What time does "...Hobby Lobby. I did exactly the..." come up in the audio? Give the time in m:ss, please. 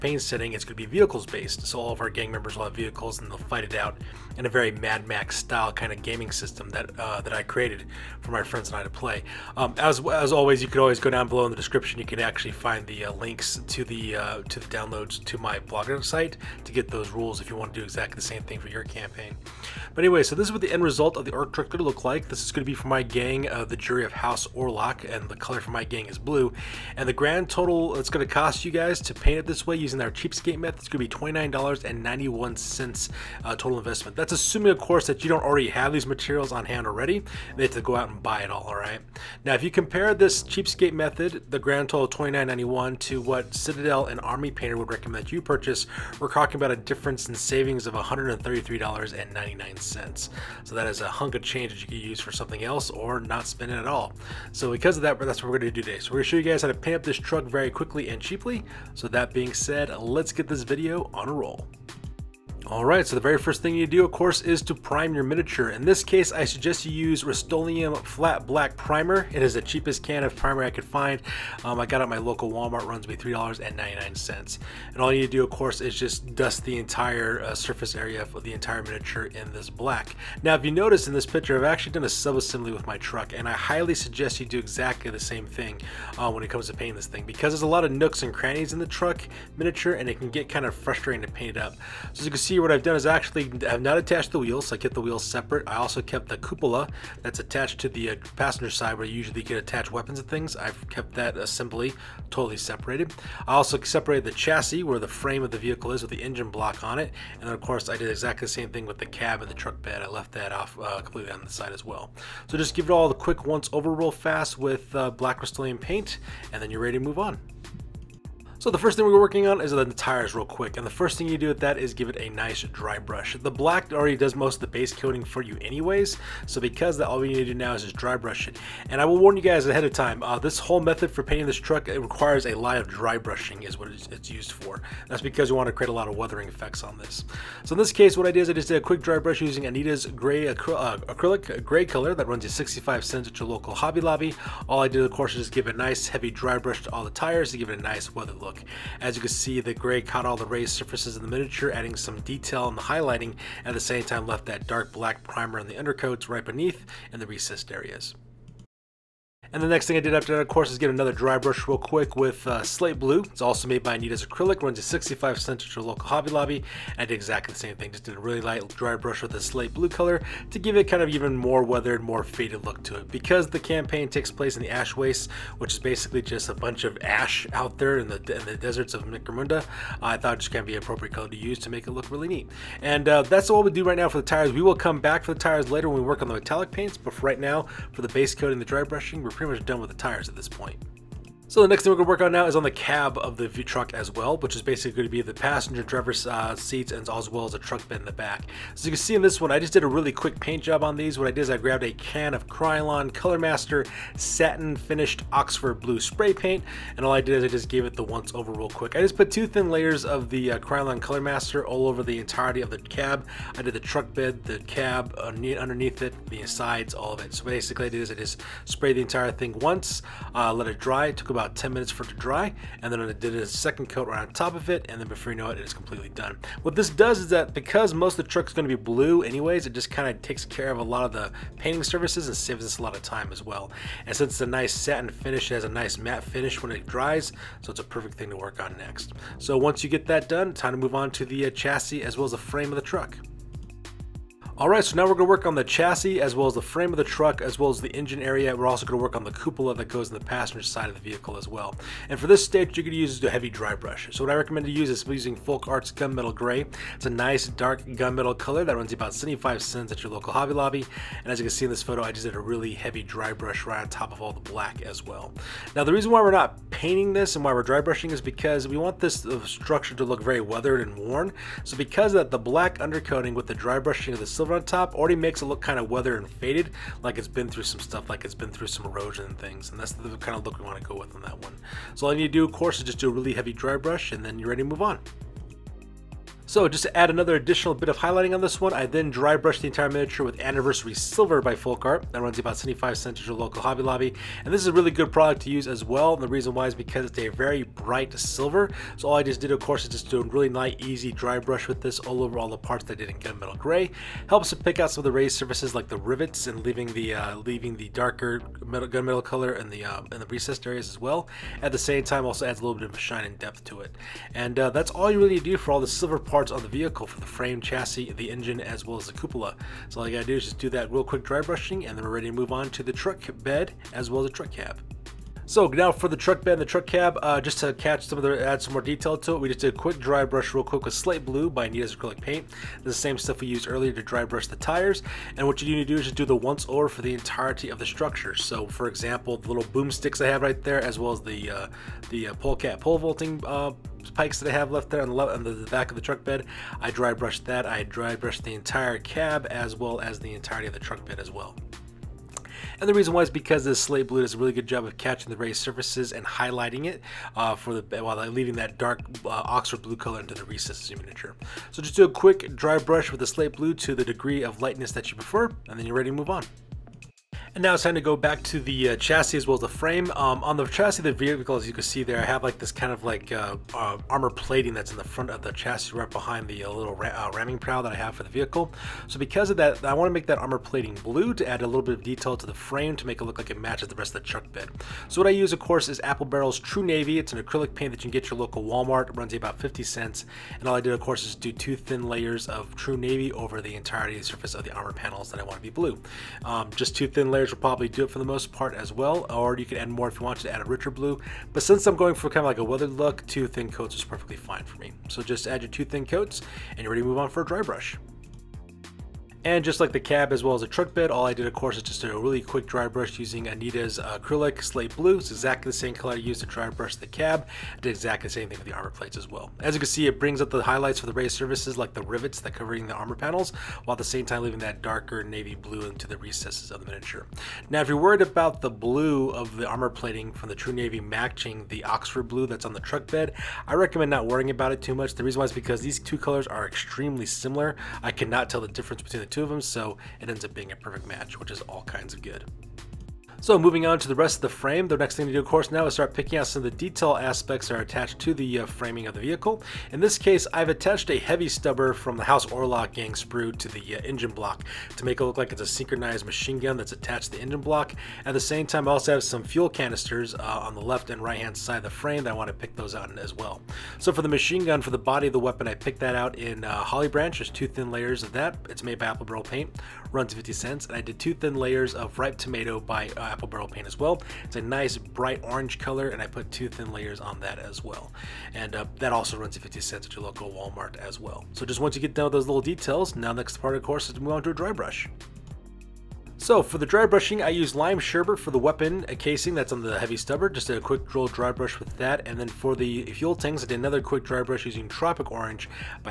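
2:46.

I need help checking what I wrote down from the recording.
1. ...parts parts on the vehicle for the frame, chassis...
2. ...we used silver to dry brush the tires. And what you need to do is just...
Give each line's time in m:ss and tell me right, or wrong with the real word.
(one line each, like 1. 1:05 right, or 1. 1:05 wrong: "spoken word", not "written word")
1. 5:16 right
2. 5:33 wrong: "earlier", not "silver".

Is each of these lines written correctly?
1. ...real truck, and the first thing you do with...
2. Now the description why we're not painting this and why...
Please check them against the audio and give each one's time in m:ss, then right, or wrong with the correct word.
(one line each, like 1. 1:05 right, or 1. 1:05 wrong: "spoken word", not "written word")
1. 2:00 wrong: "quick", not "truck"
2. 4:25 wrong: "reason", not "description".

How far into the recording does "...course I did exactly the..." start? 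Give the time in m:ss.
1:47.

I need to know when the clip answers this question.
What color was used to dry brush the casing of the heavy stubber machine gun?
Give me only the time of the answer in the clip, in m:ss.
8:07.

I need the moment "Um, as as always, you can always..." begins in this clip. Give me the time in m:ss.
0:09.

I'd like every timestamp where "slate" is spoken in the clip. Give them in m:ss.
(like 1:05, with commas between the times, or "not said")
2:42, 2:49, 5:30, 5:53, 6:03, 6:54.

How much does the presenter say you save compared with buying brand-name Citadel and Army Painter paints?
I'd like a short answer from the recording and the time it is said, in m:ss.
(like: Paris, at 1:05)
$133.99, at 0:47.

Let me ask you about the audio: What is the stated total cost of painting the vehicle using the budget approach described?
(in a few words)
$29.91.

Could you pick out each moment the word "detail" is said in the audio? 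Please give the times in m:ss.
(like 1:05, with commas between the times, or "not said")
2:32, 5:28, 6:22, 7:26, 8:02.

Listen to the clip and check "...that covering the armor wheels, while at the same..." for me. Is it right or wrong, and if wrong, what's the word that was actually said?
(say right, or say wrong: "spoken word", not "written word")
wrong: "panels", not "wheels".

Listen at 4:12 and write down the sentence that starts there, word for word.
And for this stage, you are going to use a heavy dry brush.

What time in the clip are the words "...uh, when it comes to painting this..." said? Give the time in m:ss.
1:26.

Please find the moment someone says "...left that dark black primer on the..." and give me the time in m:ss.
2:34.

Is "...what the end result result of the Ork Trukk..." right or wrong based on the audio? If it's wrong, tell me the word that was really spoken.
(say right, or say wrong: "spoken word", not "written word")
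right.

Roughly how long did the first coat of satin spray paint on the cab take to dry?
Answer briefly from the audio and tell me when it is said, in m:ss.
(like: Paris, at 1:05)
10 minutes, at 3:41.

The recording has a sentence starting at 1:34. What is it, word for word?
So I kept the wheels separate.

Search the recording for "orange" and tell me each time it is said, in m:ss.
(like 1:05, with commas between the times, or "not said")
7:55, 8:15.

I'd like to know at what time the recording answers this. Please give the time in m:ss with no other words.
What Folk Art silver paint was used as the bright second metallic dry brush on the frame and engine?
4:50.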